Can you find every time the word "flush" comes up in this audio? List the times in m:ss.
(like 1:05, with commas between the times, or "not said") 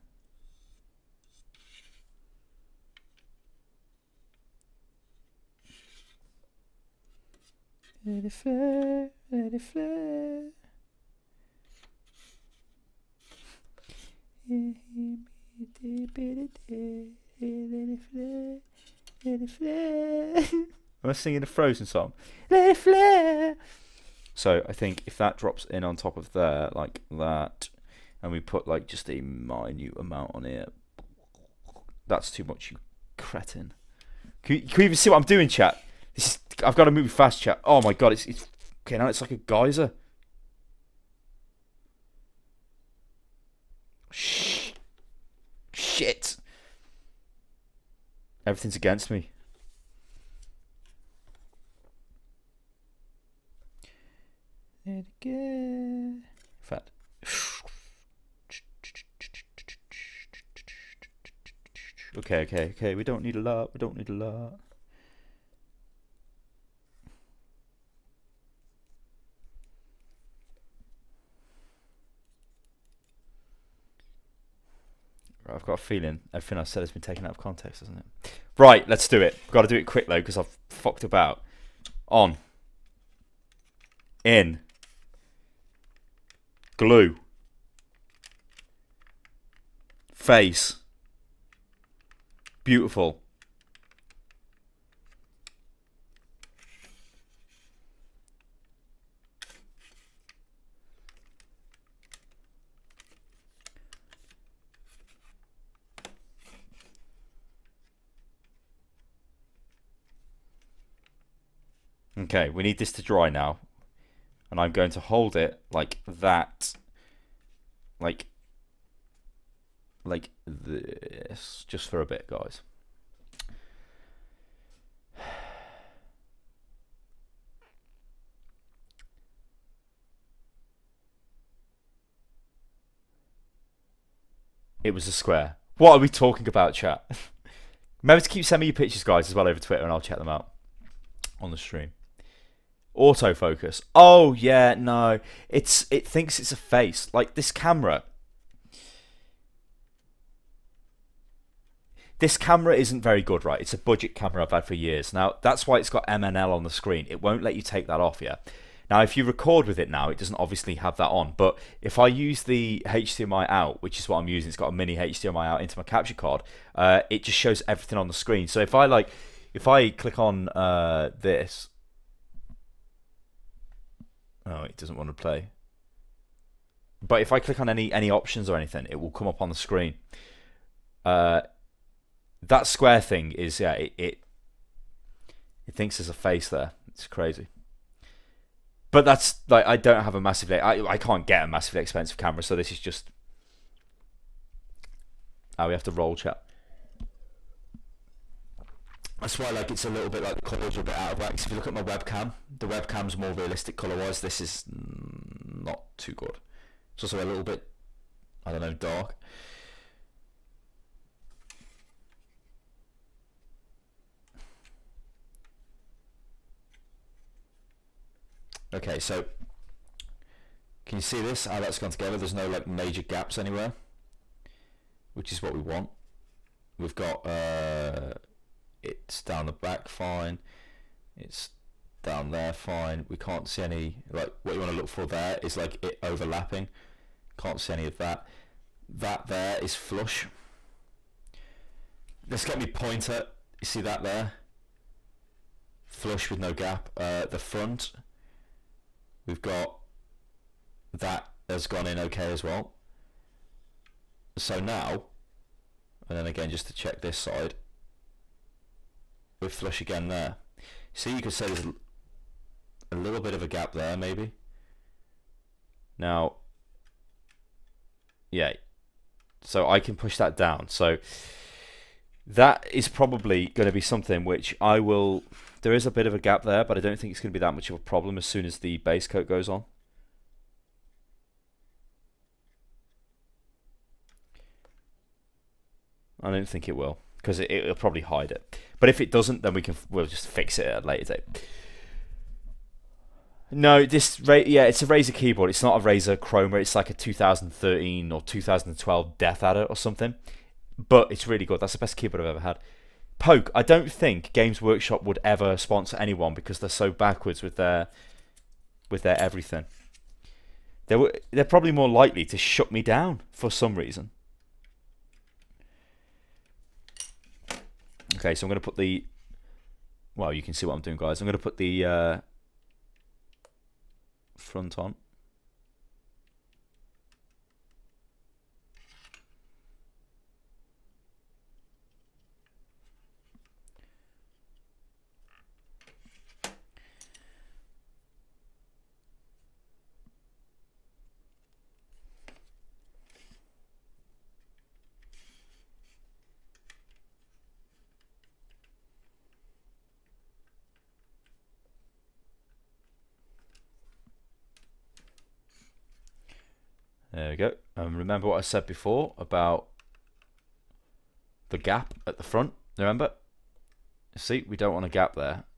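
3:59, 4:05, 4:19.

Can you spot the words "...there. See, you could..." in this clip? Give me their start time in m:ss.
4:20.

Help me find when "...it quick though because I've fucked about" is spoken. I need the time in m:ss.
1:19.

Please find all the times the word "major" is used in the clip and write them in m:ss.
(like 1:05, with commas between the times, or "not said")
3:42.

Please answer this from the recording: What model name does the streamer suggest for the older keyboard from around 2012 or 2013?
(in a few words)
Death Adder.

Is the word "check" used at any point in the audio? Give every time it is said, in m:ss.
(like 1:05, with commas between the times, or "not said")
2:20, 4:16.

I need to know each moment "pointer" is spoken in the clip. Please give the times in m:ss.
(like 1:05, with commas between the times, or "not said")
4:02.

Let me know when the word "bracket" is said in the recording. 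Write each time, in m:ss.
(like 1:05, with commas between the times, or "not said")
not said.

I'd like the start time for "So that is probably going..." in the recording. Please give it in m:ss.
4:30.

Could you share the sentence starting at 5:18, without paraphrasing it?
Okay, so I'm going to put the...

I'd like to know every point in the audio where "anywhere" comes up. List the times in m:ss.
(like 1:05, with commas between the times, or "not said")
3:43.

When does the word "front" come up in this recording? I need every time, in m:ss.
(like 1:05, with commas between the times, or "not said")
4:07, 5:24, 6:02.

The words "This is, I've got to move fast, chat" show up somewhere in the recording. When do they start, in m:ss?
0:36.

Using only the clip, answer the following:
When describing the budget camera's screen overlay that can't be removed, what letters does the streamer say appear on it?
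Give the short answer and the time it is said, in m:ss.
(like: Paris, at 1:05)
MNL, at 2:36.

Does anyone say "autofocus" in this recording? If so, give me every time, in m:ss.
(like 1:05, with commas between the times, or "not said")
2:22.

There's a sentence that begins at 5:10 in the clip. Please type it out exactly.
They were they're probably more likely to shut me down for some reason.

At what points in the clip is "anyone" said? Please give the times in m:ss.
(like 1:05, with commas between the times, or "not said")
5:05.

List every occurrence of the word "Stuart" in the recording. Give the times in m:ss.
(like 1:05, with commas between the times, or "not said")
not said.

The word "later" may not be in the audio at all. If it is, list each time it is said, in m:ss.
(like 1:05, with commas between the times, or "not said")
4:50.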